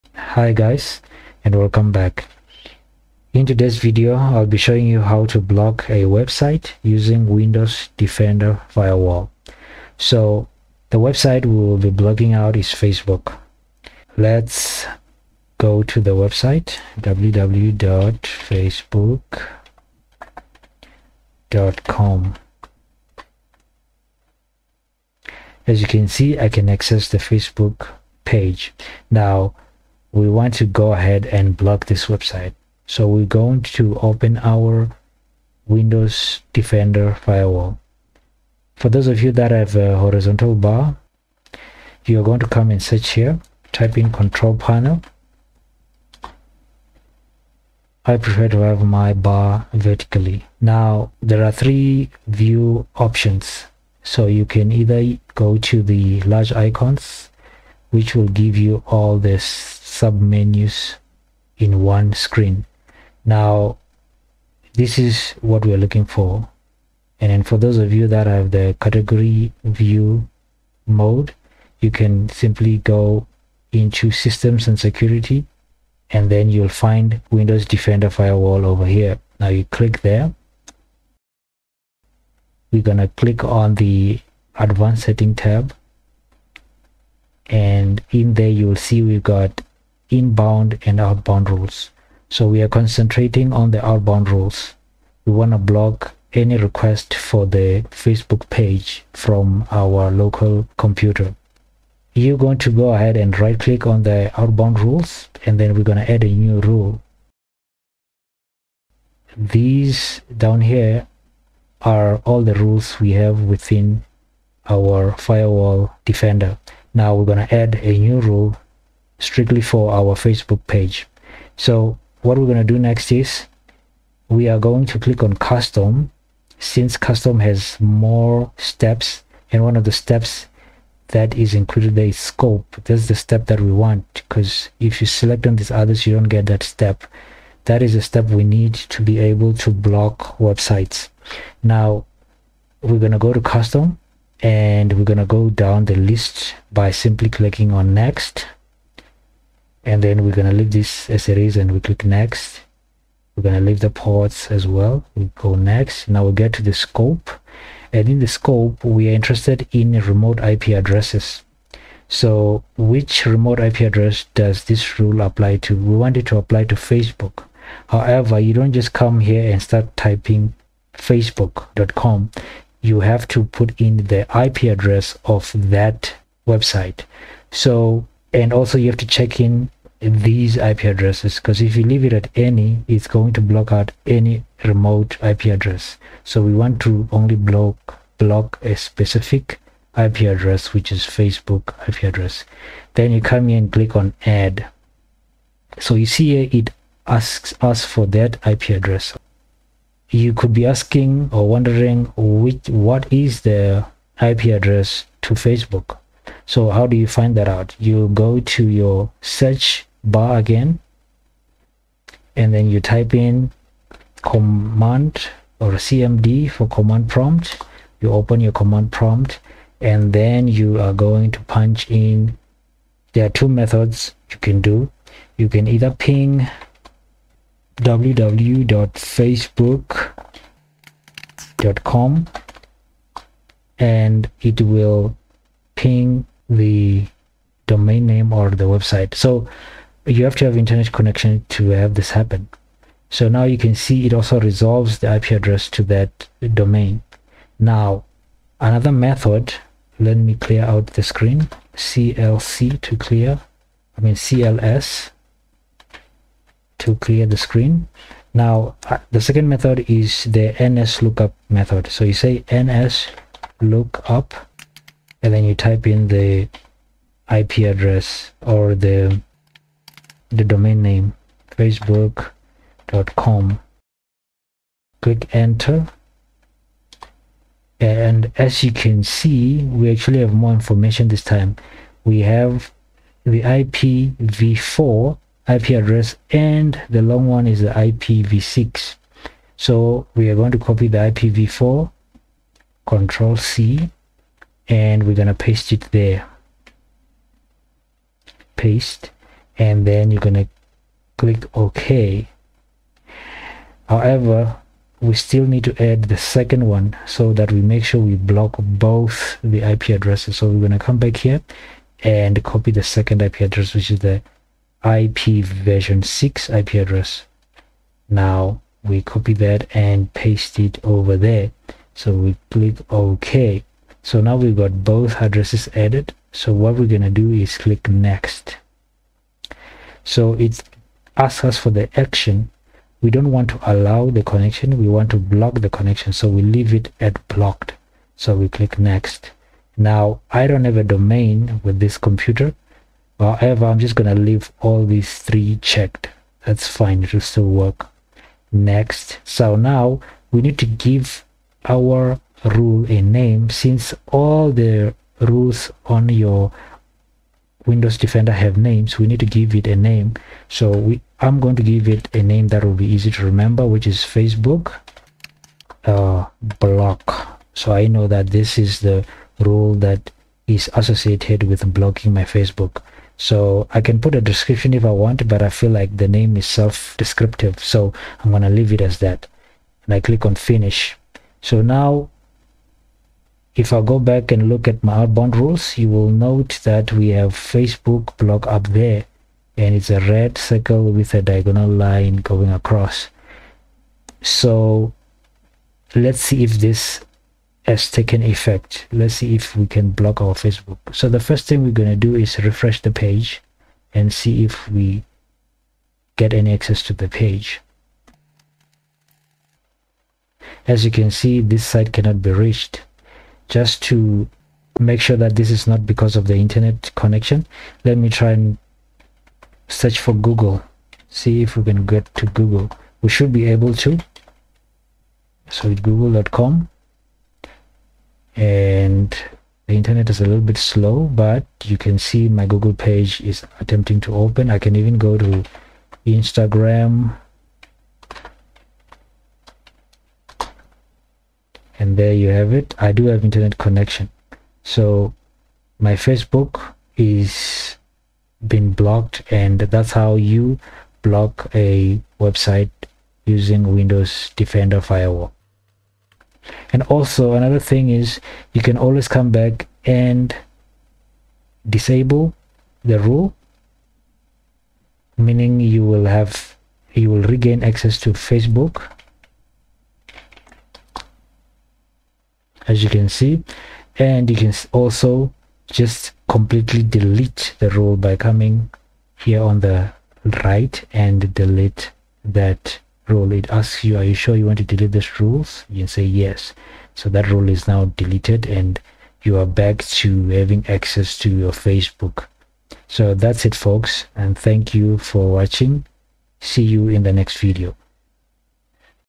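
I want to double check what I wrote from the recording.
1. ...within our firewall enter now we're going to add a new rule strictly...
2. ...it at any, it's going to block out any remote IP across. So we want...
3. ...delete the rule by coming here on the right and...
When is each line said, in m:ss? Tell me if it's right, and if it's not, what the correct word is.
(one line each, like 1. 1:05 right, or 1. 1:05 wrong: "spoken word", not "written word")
1. 1:53 wrong: "defender", not "enter"
2. 3:02 wrong: "address", not "across"
3. 7:56 right.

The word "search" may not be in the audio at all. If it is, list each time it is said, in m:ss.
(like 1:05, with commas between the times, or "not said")
0:42, 3:29, 6:59.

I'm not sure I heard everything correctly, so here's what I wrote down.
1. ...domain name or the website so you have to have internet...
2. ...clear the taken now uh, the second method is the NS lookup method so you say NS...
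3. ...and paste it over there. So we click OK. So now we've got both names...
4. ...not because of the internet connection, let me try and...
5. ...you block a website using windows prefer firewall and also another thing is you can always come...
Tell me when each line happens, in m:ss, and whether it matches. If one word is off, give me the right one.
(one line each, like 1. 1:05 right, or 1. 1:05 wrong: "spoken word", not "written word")
1. 3:57 right
2. 4:16 wrong: "screen", not "taken"
3. 5:19 wrong: "addresses", not "names"
4. 6:55 right
5. 7:30 wrong: "defender", not "prefer".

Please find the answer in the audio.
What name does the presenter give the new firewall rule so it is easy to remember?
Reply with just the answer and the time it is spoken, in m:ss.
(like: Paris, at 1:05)
Facebook block, at 6:03.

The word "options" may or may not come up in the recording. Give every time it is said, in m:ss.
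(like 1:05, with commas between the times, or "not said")
0:52.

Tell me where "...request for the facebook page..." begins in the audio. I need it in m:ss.
1:36.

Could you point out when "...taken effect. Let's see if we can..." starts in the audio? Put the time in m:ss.
6:37.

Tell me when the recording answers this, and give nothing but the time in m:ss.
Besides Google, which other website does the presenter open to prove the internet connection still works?
7:16.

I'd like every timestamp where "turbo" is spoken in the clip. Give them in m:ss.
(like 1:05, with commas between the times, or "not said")
not said.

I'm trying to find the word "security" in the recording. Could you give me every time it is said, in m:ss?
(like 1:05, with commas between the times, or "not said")
1:14.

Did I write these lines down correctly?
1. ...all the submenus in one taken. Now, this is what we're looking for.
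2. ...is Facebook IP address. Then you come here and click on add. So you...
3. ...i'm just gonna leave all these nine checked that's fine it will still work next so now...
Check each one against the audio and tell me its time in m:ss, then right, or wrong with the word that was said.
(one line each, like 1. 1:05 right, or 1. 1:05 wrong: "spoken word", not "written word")
1. 0:58 wrong: "screen", not "taken"
2. 3:10 right
3. 5:43 wrong: "three", not "nine".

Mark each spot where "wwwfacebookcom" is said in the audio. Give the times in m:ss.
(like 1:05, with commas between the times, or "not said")
0:16, 3:47.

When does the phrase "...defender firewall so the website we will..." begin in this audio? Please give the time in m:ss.
0:07.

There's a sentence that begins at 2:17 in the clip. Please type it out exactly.
That is a step we need to be able to block websites.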